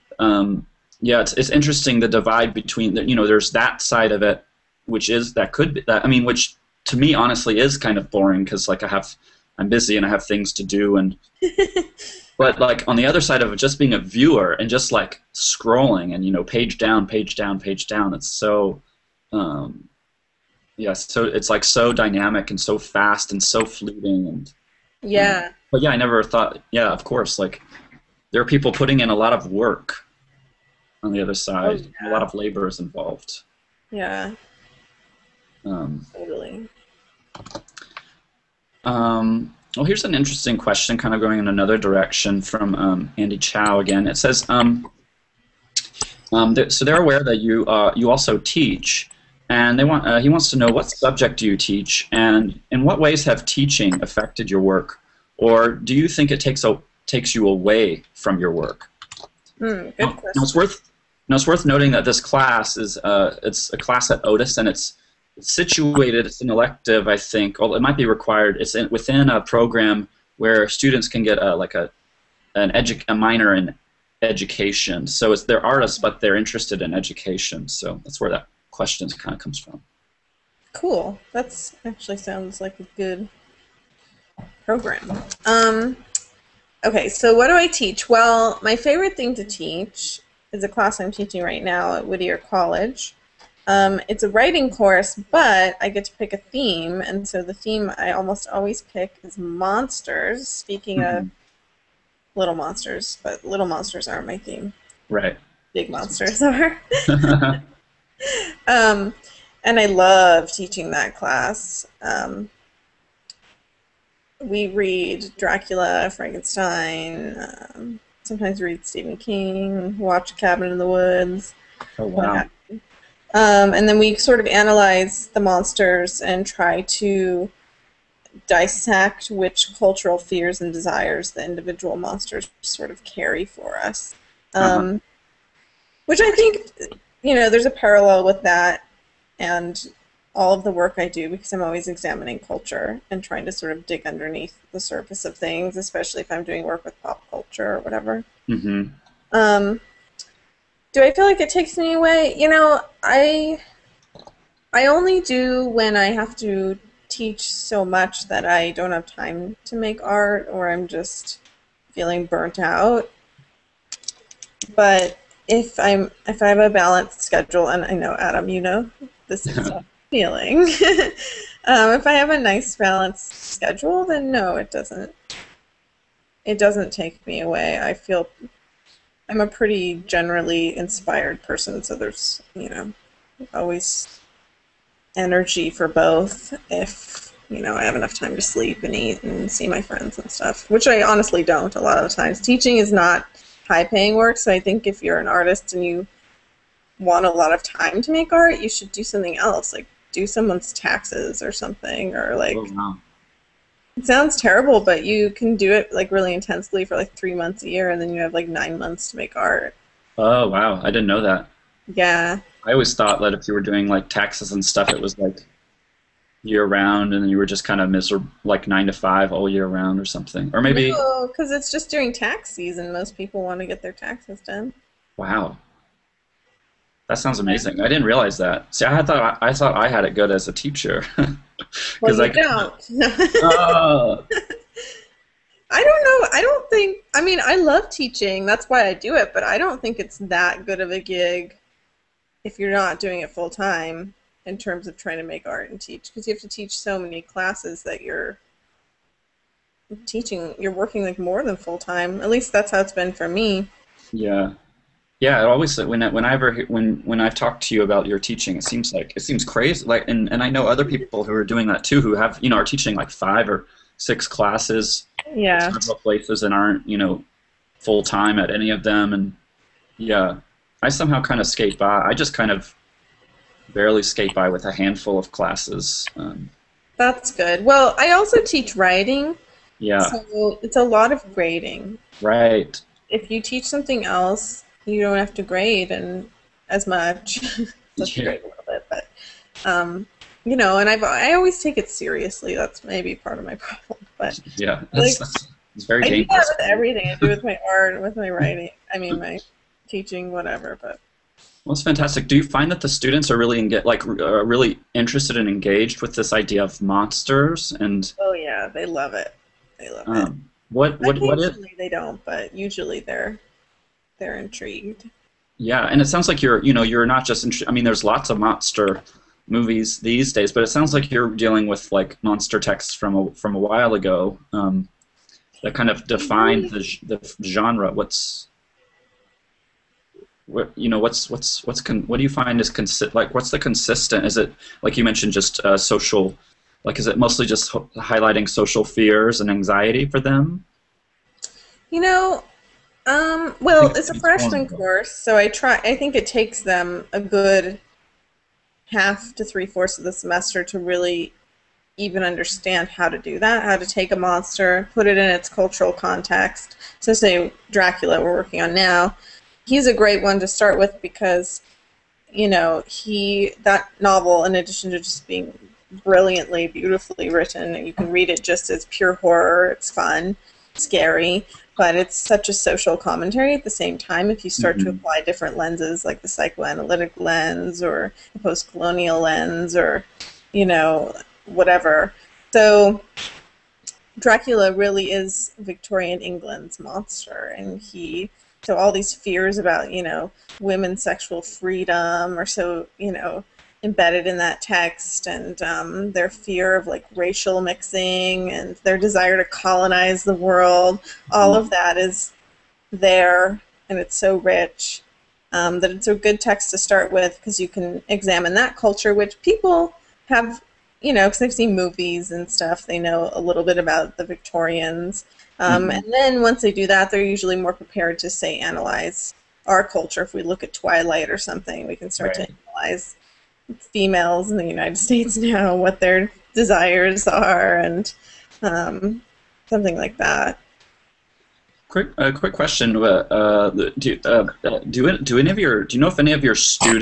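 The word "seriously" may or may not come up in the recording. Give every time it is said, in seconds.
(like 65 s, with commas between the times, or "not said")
291 s.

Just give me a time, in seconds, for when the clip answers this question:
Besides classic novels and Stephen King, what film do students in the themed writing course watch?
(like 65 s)
120 s.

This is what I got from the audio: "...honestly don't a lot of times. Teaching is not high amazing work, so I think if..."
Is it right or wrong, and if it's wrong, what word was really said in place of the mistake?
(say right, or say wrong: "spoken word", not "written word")
wrong: "paying", not "amazing".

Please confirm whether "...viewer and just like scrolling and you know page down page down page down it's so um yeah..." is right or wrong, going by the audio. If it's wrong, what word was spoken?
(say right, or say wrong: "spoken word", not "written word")
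right.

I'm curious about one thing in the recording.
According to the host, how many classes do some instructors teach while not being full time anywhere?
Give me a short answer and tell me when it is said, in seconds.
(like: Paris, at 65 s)
5 or 6, at 263 s.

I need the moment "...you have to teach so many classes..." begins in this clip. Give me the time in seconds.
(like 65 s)
246 s.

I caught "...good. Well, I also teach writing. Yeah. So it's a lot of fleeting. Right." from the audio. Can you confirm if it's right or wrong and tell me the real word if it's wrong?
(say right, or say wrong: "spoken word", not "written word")
wrong: "grading", not "fleeting".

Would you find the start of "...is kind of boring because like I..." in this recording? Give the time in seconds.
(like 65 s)
7 s.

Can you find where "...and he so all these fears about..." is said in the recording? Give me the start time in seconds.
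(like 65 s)
387 s.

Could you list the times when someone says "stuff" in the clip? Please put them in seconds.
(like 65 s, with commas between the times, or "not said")
190 s, 214 s, 412 s.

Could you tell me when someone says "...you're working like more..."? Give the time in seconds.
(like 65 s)
250 s.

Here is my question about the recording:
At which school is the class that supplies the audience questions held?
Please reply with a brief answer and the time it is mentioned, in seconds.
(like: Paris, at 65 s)
Otis, at 64 s.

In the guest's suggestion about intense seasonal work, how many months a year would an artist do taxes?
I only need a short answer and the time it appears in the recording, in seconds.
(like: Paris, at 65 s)
3, at 207 s.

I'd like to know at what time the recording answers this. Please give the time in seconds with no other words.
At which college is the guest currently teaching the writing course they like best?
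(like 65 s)
92 s.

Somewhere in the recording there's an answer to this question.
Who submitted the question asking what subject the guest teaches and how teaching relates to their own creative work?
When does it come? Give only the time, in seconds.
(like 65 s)
43 s.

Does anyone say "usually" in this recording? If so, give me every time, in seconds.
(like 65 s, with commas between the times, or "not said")
312 s, 417 s.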